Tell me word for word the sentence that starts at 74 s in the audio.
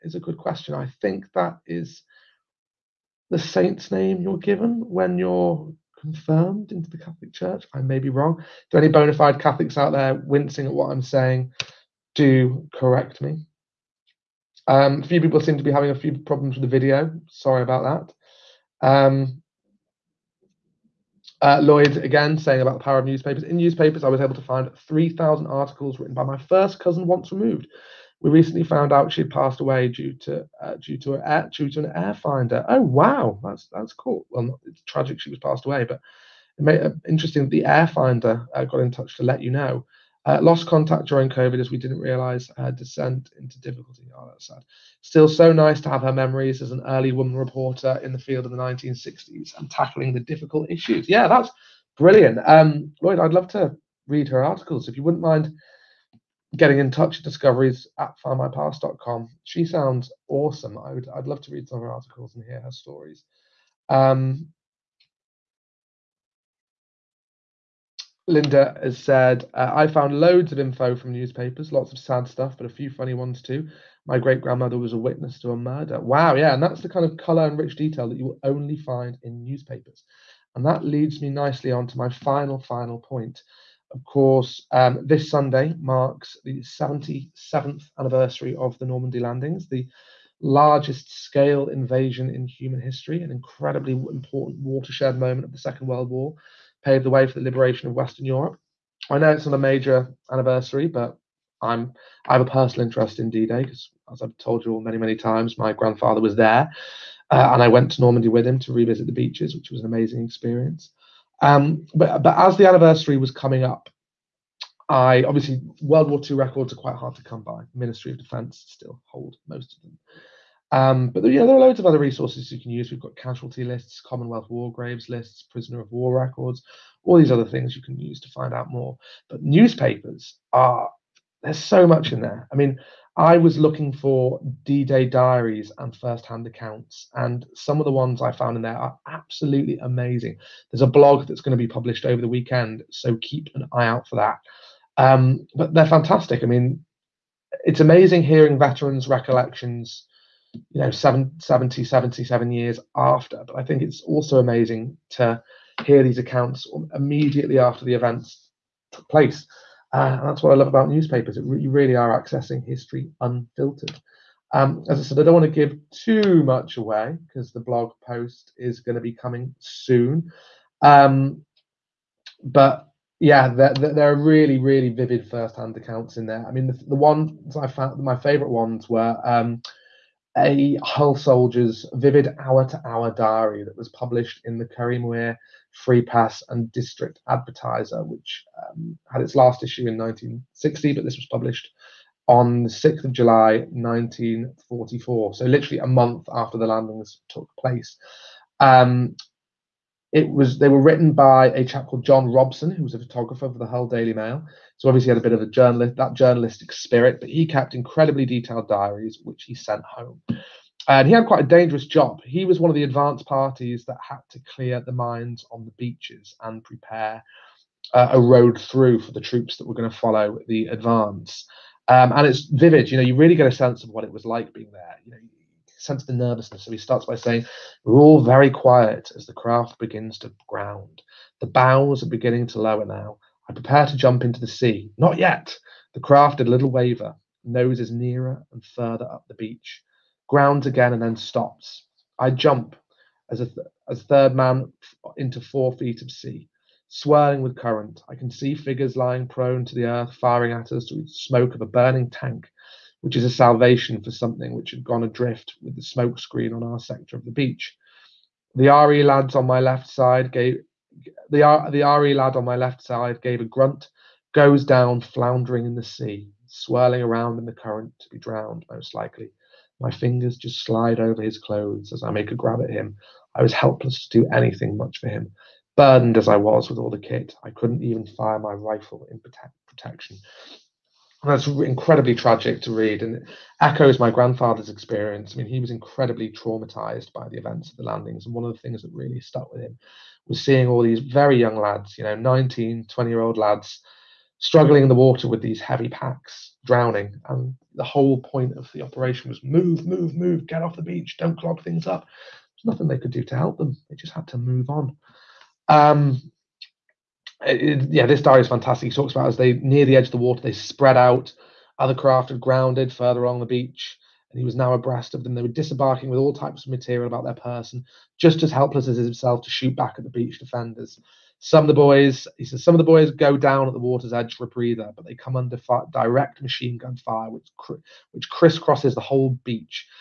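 My great grandmother was a witness to a murder.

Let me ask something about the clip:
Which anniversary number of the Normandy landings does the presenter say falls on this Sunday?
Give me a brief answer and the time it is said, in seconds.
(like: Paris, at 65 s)
77th, at 86 s.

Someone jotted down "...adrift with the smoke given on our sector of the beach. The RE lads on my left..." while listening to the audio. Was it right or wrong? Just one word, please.
wrong.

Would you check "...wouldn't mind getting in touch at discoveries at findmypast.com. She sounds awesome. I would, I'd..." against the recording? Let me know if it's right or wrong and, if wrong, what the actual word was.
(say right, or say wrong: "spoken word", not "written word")
right.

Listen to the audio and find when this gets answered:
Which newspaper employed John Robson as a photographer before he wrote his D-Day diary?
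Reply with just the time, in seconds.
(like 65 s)
203 s.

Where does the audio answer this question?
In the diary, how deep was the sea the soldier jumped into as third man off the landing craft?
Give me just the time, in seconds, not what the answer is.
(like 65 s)
245 s.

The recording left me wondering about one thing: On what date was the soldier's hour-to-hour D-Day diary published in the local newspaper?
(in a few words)
6 July 1944.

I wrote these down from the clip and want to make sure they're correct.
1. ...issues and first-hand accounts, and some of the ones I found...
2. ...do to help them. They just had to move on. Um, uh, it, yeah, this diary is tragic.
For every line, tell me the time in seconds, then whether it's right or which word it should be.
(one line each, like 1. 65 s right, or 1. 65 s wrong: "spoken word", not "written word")
1. 135 s wrong: "diaries", not "issues"
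2. 303 s wrong: "fantastic", not "tragic".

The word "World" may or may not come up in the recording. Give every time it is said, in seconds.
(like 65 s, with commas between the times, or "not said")
95 s, 115 s.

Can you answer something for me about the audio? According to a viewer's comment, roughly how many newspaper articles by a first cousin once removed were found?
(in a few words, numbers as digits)
3,000.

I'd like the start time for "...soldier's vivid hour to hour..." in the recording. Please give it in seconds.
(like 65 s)
181 s.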